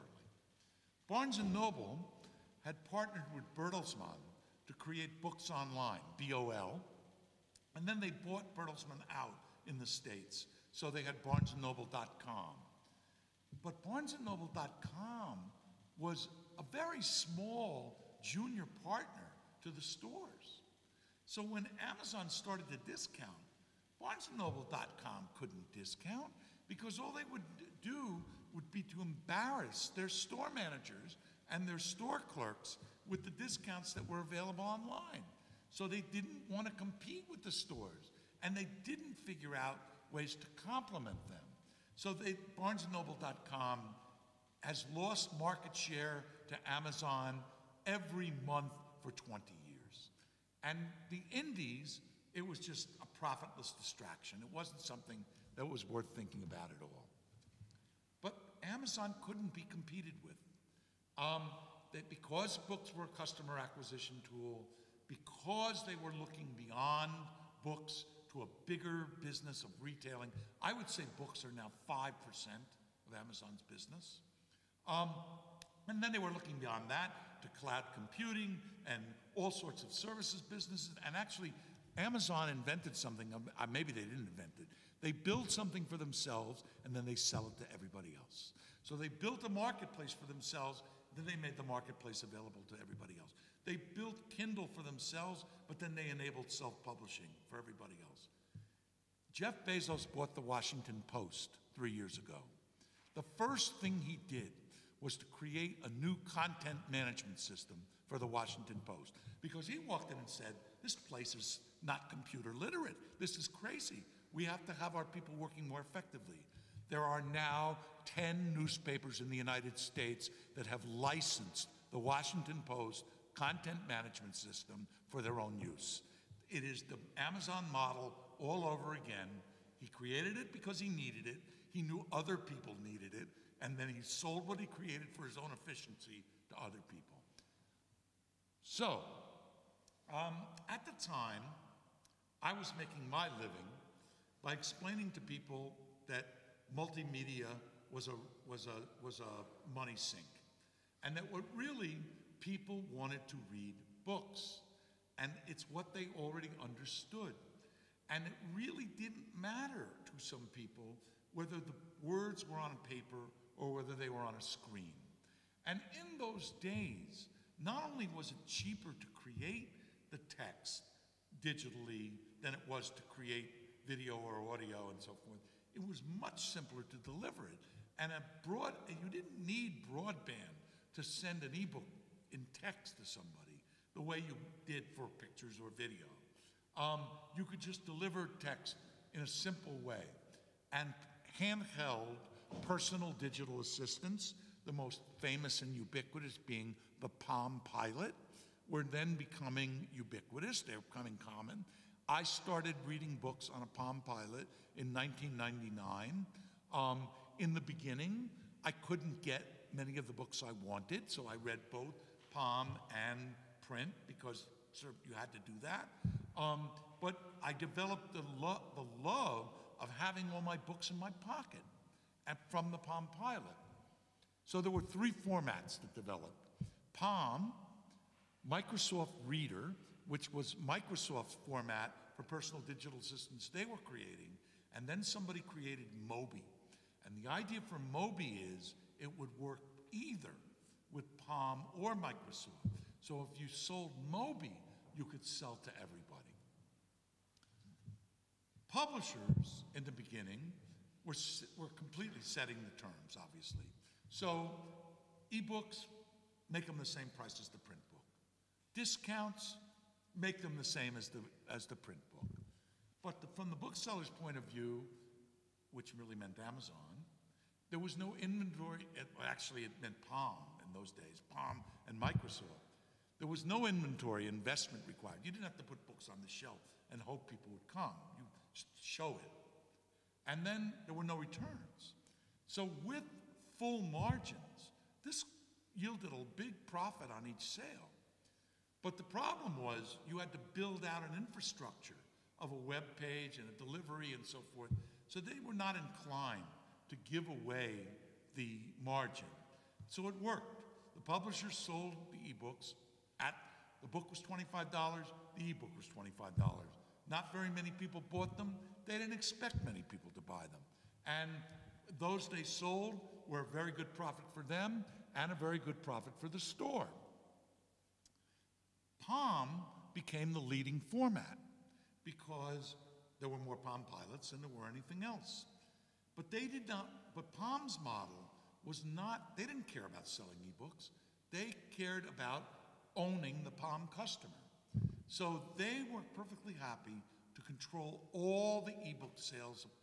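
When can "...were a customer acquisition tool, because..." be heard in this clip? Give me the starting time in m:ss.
1:02.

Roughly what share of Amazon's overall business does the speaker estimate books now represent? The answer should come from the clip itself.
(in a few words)
5%.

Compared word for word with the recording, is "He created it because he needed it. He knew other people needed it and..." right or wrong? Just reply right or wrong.
right.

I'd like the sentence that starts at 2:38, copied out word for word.
And it really didn't matter to some people whether the words were on paper or whether they were on a screen.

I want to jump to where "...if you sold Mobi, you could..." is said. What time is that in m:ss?
4:03.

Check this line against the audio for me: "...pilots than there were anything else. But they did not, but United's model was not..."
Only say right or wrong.
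wrong.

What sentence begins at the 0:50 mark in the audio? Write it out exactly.
And the indies it was just a profitless distraction.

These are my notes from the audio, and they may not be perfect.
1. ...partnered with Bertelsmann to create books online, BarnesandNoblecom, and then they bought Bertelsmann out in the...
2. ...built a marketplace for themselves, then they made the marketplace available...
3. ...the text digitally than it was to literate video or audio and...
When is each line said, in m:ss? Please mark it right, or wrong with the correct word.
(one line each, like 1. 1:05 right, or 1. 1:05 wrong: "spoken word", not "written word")
1. 0:02 wrong: "BOL", not "BarnesandNoblecom"
2. 1:29 right
3. 2:50 wrong: "create", not "literate".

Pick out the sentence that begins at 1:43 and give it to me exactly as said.
The first thing he did was to create a new content management system for the Washington Post.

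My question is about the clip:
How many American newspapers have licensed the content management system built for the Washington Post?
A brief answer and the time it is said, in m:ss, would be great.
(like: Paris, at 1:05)
10, at 1:58.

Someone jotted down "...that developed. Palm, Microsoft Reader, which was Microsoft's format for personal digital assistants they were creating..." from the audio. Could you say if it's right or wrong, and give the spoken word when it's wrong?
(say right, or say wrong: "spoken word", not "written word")
right.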